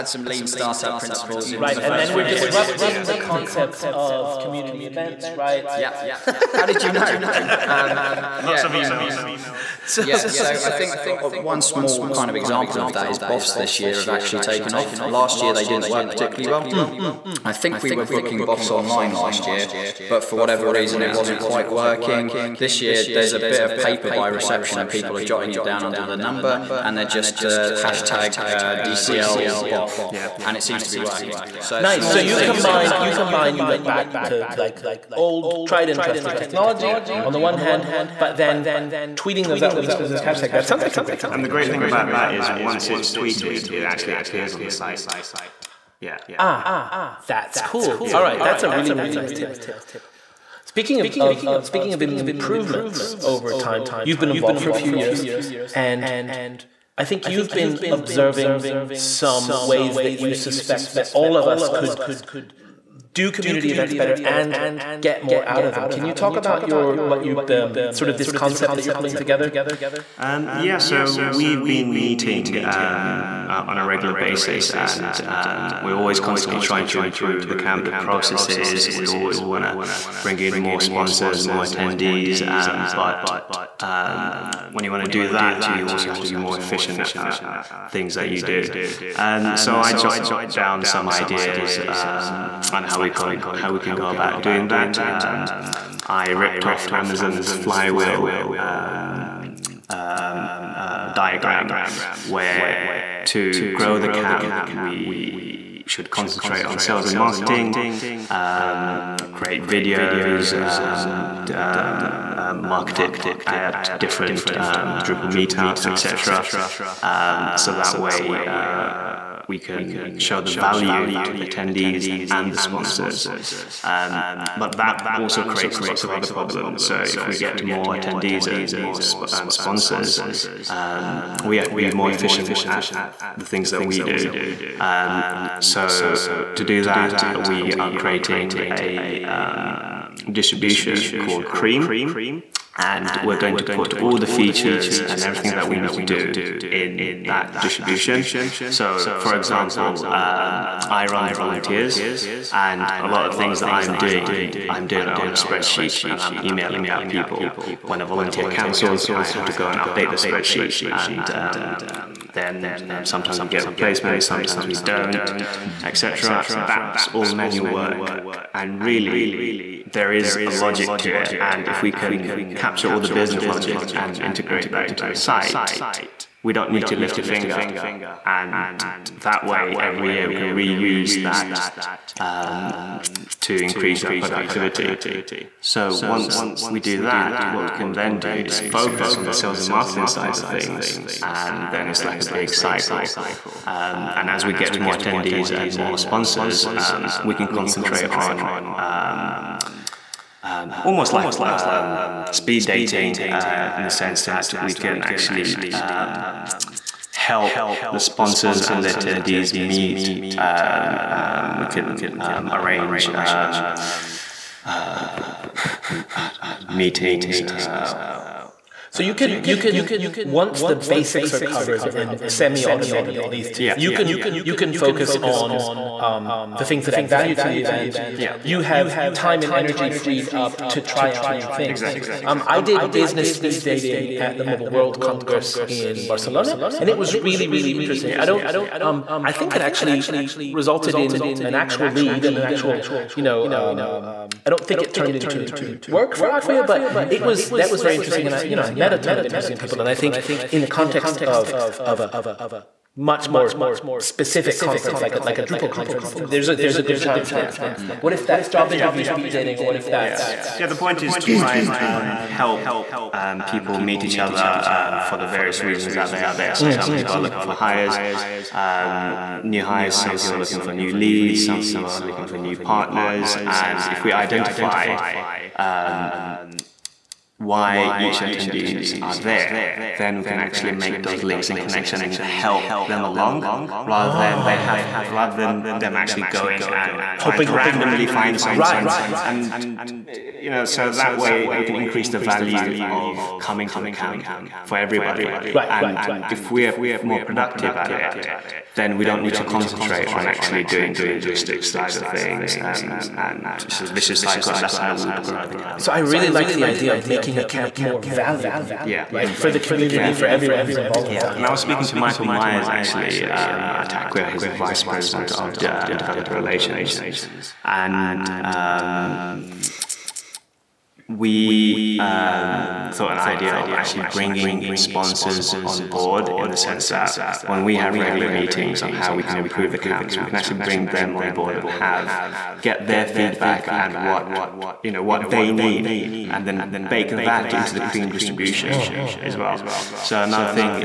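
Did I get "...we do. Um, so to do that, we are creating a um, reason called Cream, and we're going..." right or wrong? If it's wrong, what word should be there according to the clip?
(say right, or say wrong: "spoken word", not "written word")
wrong: "distribution", not "reason".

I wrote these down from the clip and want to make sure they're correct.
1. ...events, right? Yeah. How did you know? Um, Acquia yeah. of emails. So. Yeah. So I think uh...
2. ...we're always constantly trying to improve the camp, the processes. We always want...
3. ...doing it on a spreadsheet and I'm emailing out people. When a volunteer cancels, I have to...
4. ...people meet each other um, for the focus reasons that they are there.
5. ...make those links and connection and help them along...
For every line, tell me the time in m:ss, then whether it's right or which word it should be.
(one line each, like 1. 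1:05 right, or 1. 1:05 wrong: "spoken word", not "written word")
1. 0:04 wrong: "Lots", not "Acquia"
2. 1:15 right
3. 2:34 right
4. 4:23 wrong: "various", not "focus"
5. 4:40 right.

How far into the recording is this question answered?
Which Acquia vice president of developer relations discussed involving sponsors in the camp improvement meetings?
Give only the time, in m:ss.
5:11.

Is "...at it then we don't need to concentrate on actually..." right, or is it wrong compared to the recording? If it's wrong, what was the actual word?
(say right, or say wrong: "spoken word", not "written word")
right.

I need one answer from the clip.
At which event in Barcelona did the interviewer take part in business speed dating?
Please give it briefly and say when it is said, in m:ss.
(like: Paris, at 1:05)
Mobile World Congress, at 3:54.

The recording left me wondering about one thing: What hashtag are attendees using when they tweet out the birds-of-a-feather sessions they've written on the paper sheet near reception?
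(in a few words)
DCL BoF.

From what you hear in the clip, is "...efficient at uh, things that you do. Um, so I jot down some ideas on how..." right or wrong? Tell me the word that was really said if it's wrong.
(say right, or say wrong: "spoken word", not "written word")
right.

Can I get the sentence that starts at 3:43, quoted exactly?
you can you can focus on um, the things that add value to the event.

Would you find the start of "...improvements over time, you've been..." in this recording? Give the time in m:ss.
0:52.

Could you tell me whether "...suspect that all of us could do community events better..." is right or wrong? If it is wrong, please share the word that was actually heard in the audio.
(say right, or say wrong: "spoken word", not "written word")
right.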